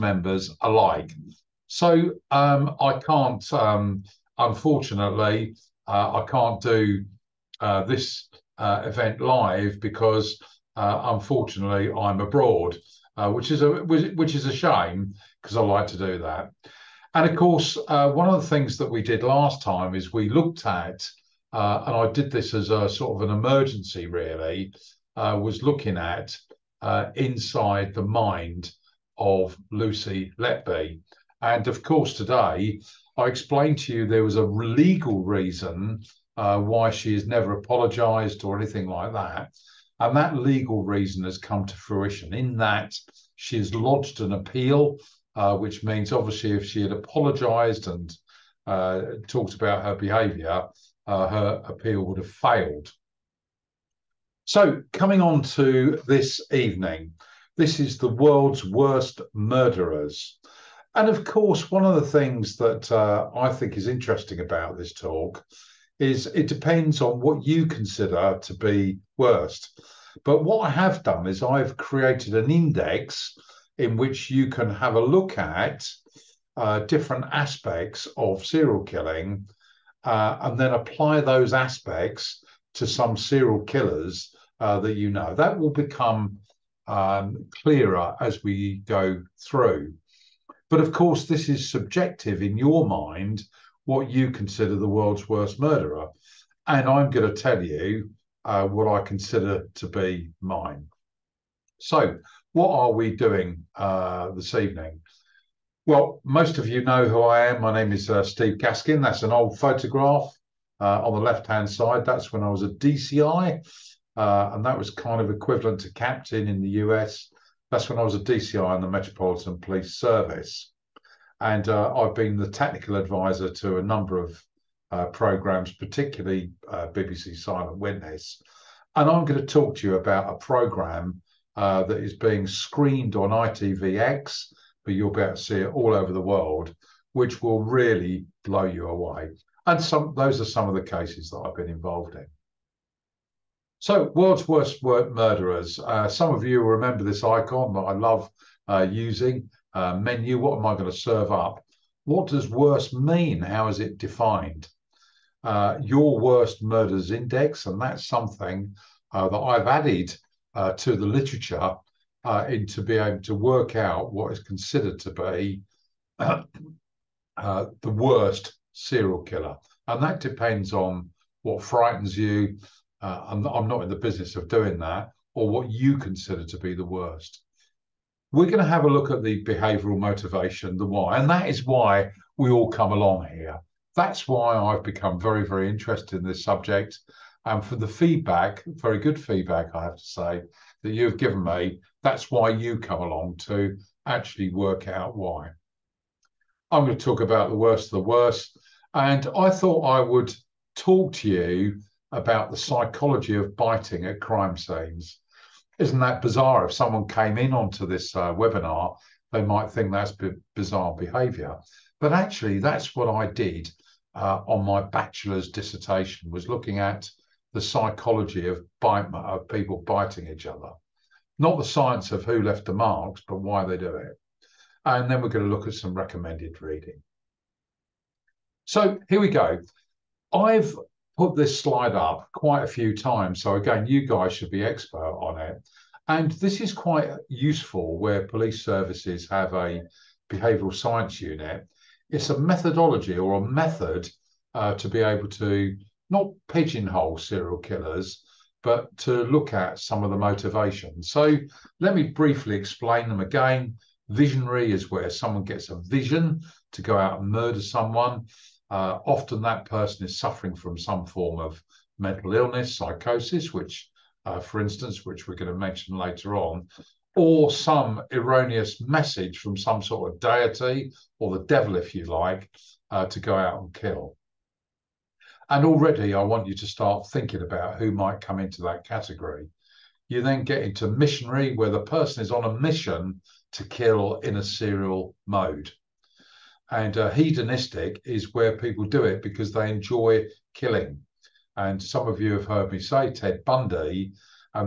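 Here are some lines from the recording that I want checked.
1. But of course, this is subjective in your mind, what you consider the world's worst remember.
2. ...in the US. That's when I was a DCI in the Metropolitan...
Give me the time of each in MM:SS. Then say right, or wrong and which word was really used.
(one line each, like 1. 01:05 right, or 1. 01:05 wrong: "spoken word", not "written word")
1. 01:30 wrong: "murderer", not "remember"
2. 01:56 right.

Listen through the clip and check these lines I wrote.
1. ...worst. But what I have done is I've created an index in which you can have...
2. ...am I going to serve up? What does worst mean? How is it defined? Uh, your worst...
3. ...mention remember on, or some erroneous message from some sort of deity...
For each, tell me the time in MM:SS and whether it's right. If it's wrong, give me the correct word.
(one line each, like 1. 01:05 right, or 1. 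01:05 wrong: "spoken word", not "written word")
1. 01:09 right
2. 02:30 right
3. 04:25 wrong: "later", not "remember".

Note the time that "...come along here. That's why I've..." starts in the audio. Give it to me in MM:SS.
03:02.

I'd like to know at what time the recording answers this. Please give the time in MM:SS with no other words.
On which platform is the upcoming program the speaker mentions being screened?
02:13.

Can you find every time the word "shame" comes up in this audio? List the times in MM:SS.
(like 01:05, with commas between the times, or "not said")
00:14.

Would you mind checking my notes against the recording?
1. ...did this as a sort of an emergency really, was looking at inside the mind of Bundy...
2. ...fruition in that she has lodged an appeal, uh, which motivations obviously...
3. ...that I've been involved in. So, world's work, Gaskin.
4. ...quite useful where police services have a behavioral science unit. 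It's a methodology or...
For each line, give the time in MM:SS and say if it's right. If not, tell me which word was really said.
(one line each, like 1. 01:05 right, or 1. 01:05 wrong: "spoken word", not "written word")
1. 00:22 wrong: "Lucy", not "Bundy"
2. 00:41 wrong: "means", not "motivations"
3. 02:21 wrong: "Murderers", not "Gaskin"
4. 03:56 right.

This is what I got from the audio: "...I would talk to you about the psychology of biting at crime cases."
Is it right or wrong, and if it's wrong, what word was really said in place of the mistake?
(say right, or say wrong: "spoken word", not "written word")
wrong: "scenes", not "cases".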